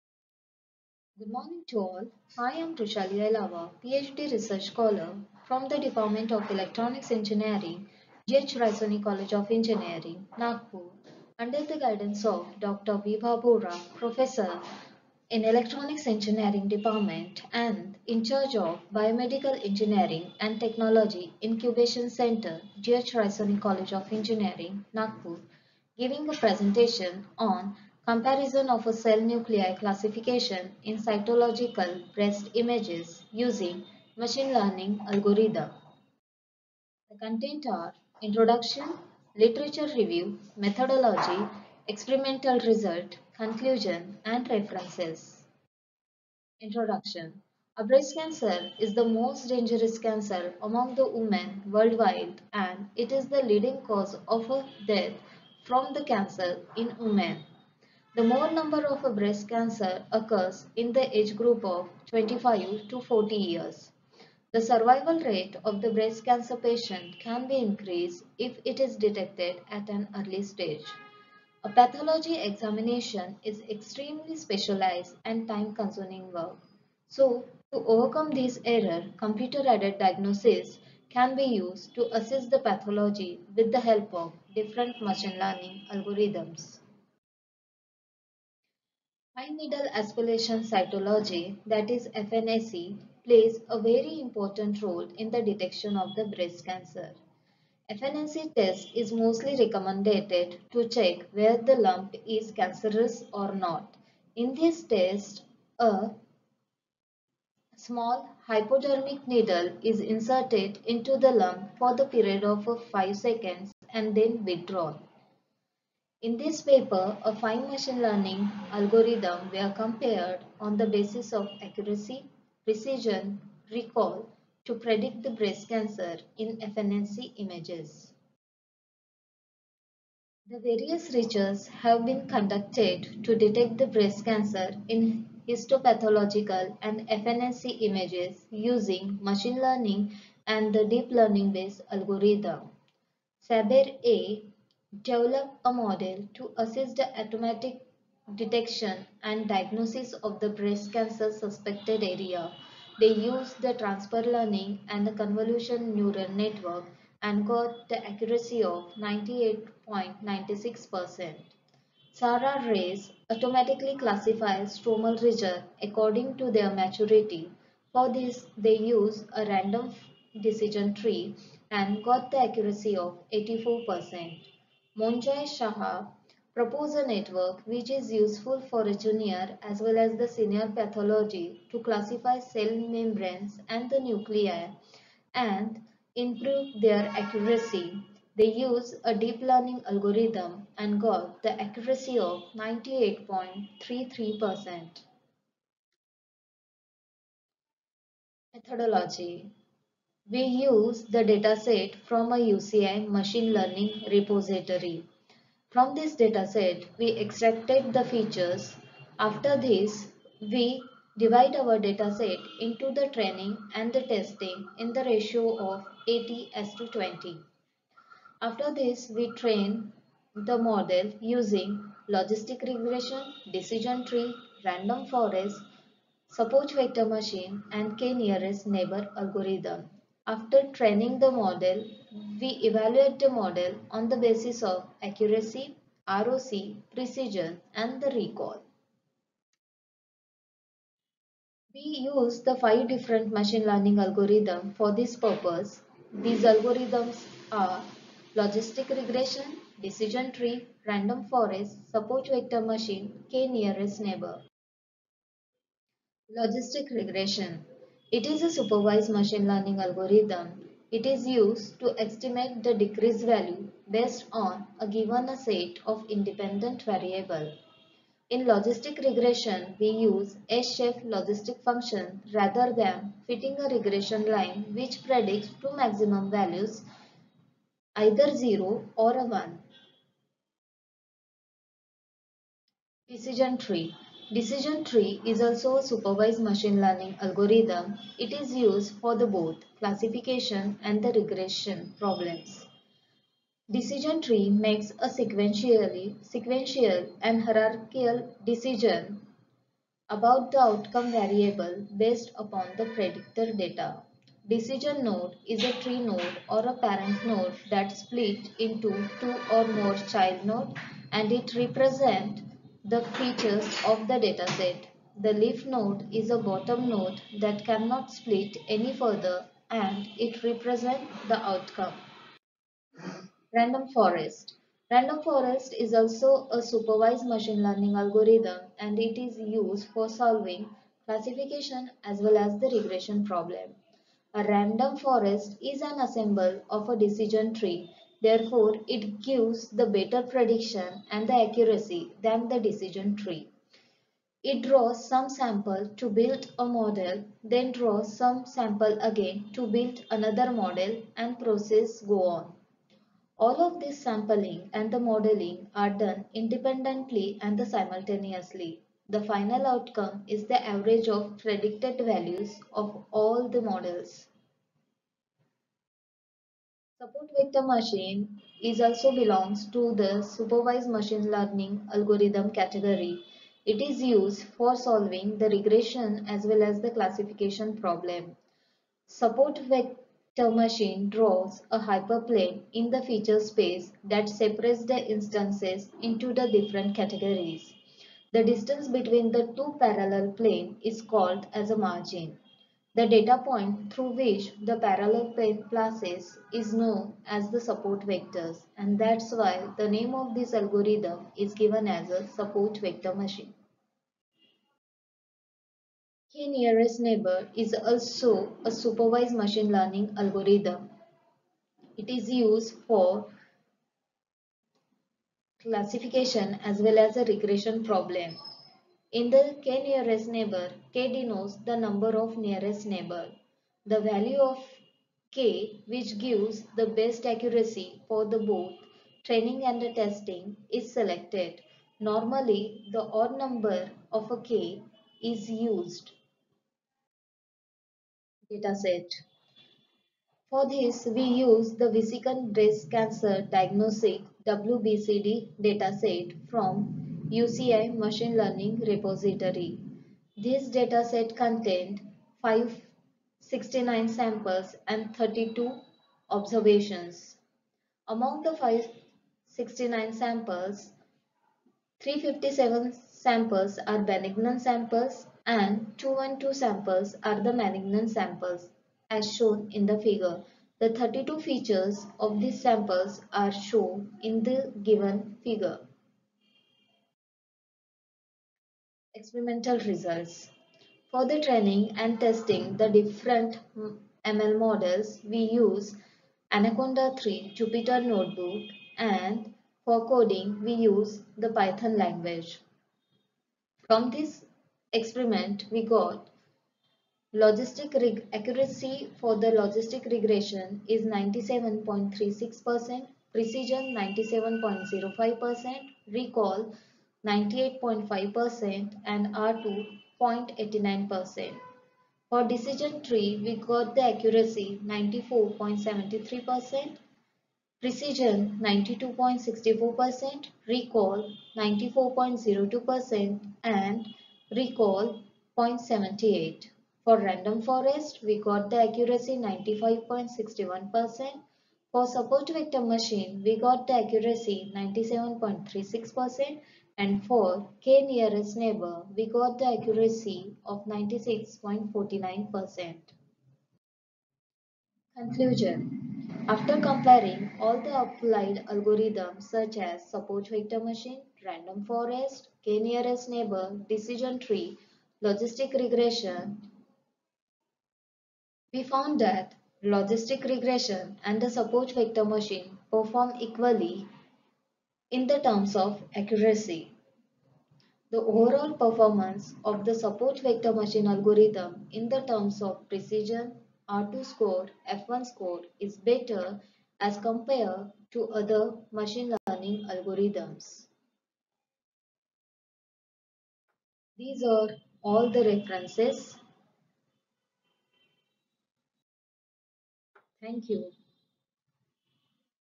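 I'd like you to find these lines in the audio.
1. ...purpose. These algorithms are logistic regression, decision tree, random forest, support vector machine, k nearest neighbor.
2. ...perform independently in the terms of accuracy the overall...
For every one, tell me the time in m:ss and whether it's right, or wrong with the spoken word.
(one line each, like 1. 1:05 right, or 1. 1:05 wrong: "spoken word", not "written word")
1. 4:05 right
2. 9:22 wrong: "equally", not "independently".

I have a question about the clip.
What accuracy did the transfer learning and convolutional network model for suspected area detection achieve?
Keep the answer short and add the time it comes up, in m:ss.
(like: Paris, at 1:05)
98.96%, at 2:38.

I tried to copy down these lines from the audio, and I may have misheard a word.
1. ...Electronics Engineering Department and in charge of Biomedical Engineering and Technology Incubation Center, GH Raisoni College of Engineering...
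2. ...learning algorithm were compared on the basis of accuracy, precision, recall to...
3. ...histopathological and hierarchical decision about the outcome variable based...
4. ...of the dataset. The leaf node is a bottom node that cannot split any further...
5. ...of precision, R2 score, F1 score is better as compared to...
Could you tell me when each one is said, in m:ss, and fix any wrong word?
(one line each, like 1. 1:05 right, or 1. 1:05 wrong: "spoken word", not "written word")
1. 0:15 right
2. 1:57 right
3. 4:56 wrong: "sequential", not "histopathological"
4. 5:13 right
5. 9:32 right.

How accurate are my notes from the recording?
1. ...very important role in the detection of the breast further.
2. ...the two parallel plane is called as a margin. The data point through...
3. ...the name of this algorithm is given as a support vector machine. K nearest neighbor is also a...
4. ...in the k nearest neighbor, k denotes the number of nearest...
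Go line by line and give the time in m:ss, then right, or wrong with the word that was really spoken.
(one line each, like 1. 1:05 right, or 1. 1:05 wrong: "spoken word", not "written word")
1. 1:33 wrong: "cancer", not "further"
2. 6:29 right
3. 6:39 right
4. 6:59 right.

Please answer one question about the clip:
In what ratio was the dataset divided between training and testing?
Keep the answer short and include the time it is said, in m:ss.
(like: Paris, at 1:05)
80 to 20, at 3:36.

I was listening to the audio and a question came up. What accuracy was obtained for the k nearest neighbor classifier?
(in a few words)
96.49%.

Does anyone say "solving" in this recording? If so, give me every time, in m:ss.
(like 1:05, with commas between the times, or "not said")
5:30, 6:14.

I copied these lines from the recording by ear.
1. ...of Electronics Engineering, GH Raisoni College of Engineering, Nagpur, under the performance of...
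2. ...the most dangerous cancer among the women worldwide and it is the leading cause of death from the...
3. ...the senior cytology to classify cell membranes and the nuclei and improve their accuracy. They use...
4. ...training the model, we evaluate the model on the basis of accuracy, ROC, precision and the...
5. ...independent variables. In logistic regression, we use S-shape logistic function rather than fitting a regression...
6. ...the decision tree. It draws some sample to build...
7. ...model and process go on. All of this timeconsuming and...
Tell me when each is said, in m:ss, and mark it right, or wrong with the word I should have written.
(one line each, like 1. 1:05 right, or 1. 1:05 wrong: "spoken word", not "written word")
1. 0:06 wrong: "guidance", not "performance"
2. 0:48 right
3. 3:00 wrong: "pathology", not "cytology"
4. 3:50 right
5. 4:26 right
6. 5:42 right
7. 5:50 wrong: "sampling", not "timeconsuming".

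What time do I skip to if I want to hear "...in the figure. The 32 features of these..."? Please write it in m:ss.
7:49.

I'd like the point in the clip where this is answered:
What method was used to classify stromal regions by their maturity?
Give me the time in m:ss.
2:49.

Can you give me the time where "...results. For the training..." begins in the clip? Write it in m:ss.
7:59.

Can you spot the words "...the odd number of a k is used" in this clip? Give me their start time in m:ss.
7:12.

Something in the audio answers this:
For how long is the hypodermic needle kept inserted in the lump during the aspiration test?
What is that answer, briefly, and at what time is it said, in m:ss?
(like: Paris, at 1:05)
5 seconds, at 1:52.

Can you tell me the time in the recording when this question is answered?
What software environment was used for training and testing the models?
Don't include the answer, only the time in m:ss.
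8:06.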